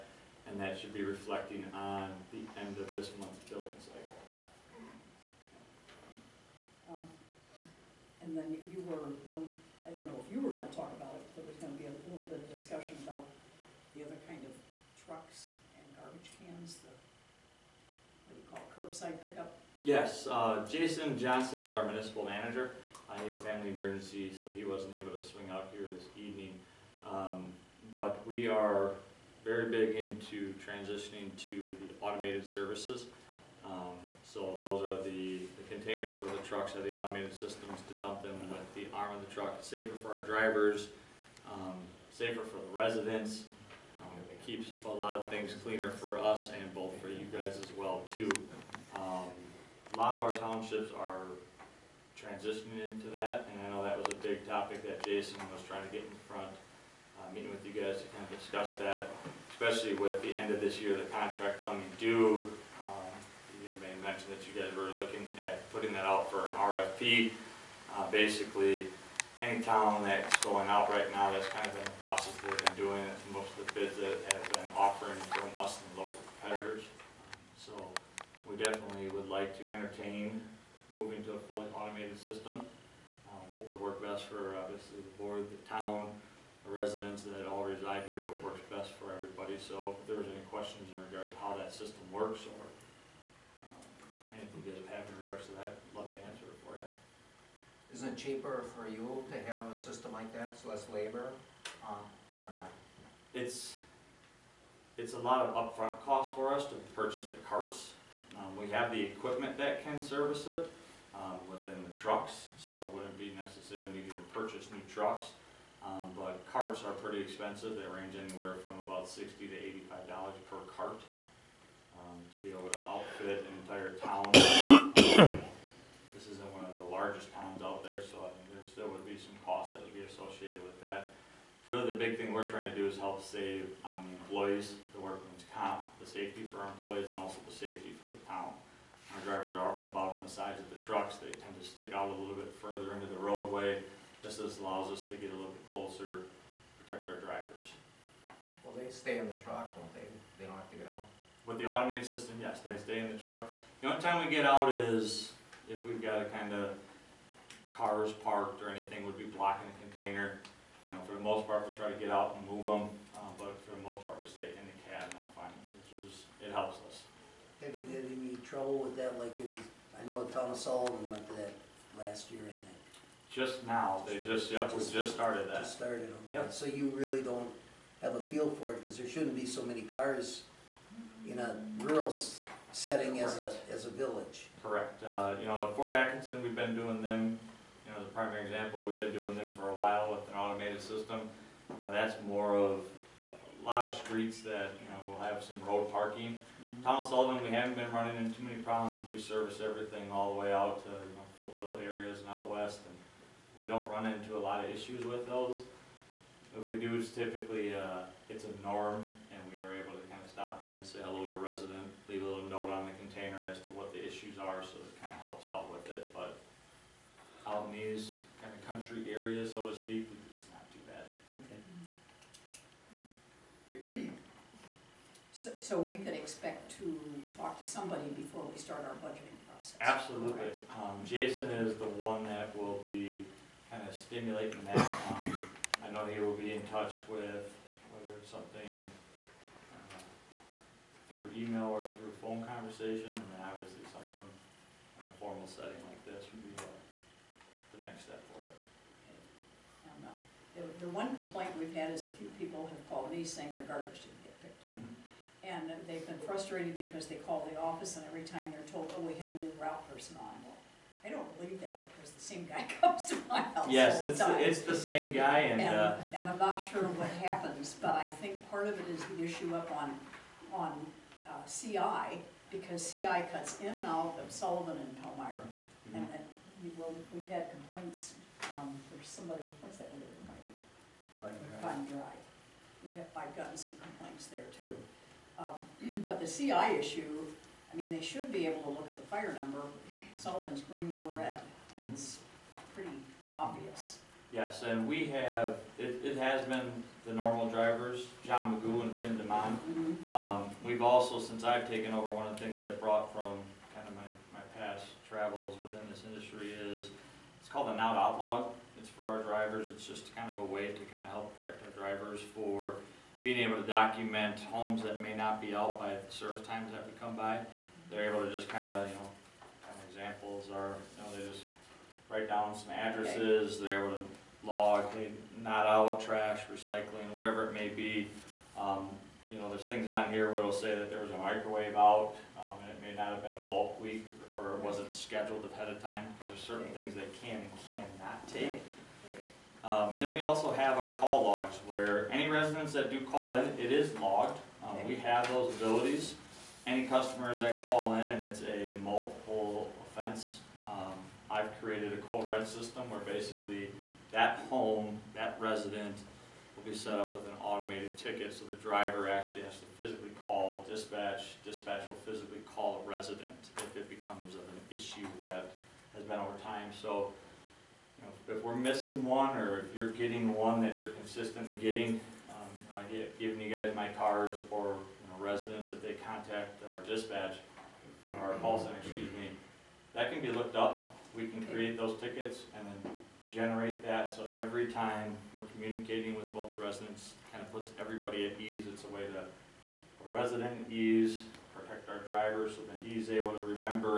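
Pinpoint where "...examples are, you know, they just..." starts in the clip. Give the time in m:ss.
5:19.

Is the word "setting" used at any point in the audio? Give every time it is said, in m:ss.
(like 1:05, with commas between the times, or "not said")
3:02, 4:05.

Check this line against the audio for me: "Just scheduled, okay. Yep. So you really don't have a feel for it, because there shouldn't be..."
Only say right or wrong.
wrong.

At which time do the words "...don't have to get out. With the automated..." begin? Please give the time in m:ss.
2:30.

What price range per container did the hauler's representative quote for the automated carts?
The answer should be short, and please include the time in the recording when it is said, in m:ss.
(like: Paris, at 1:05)
$60 to $85, at 1:59.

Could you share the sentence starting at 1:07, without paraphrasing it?
Uh, Basically, any town that's going out right now, that's kind of been the process they've been doing, it.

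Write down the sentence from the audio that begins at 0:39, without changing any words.
It's safer for our drivers, um, safer for the residents.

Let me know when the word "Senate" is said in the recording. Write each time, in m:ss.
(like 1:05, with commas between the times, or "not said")
not said.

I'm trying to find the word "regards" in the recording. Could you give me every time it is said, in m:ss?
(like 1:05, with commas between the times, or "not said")
1:31, 1:35.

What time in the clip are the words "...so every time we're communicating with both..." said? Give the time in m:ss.
6:24.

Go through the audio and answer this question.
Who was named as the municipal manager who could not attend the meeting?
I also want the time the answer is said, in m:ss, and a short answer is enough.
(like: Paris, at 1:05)
Jason Johnson, at 0:20.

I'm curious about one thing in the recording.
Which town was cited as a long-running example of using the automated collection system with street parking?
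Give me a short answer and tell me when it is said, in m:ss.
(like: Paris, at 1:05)
Fort Atkinson, at 3:05.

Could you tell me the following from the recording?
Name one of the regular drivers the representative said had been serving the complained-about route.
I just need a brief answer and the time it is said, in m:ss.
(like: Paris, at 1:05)
Tim DeMond, at 4:58.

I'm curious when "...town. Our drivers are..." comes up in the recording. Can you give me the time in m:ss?
2:18.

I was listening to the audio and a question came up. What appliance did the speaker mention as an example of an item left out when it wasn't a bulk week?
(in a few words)
microwave.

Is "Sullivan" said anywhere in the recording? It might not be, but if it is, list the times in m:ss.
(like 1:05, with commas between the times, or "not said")
2:50, 3:17, 4:34, 4:50.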